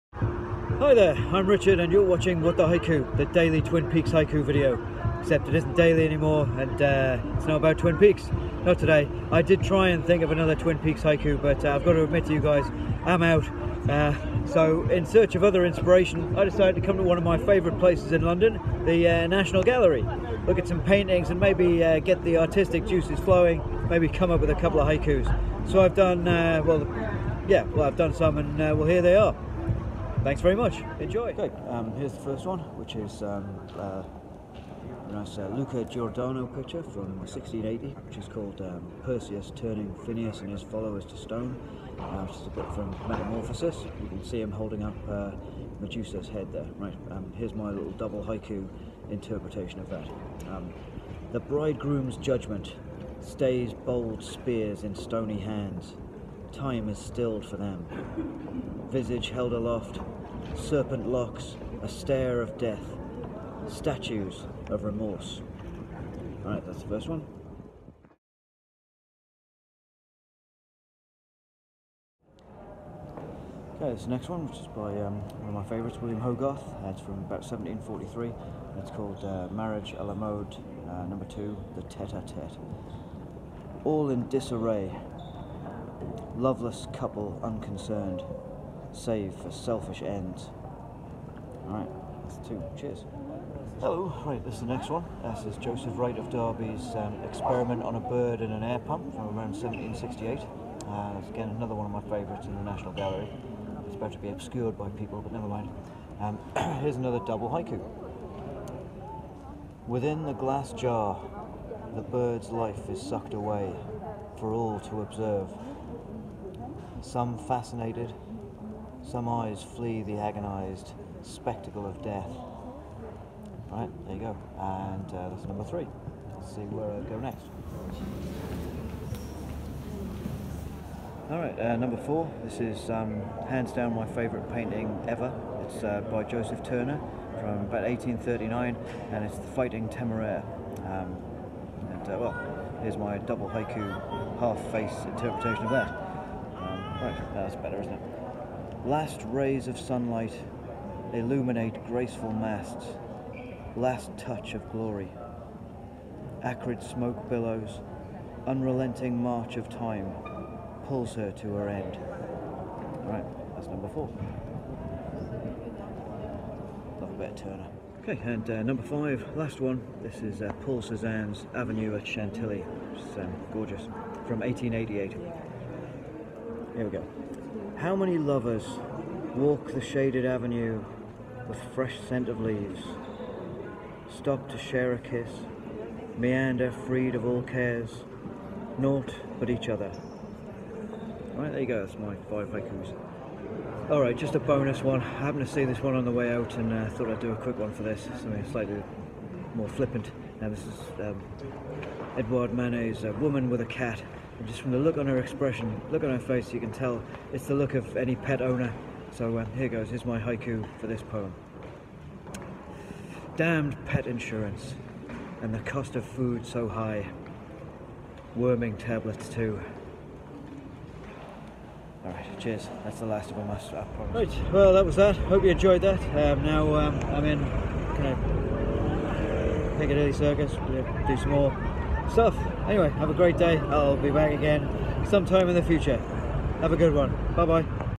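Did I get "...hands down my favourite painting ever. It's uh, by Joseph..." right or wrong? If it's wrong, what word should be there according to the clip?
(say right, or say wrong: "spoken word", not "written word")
right.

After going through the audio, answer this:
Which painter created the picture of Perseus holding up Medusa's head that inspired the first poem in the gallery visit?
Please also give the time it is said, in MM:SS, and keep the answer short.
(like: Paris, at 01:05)
Luca Giordano, at 00:35.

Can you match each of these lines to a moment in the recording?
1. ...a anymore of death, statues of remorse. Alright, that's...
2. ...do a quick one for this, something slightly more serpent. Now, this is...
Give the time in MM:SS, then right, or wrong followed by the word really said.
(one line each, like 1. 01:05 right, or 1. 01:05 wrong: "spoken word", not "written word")
1. 01:01 wrong: "stare", not "anymore"
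2. 03:17 wrong: "flippant", not "serpent".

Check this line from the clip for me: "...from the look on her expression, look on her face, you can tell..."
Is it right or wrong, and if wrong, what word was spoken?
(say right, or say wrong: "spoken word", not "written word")
right.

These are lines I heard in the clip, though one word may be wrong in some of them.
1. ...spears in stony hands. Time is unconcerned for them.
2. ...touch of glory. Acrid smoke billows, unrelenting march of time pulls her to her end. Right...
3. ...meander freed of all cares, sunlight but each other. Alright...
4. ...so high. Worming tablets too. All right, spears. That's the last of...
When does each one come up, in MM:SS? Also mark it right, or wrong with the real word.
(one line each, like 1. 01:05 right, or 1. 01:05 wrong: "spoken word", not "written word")
1. 00:54 wrong: "stilled", not "unconcerned"
2. 02:34 right
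3. 03:06 wrong: "naught", not "sunlight"
4. 03:36 wrong: "cheers", not "spears".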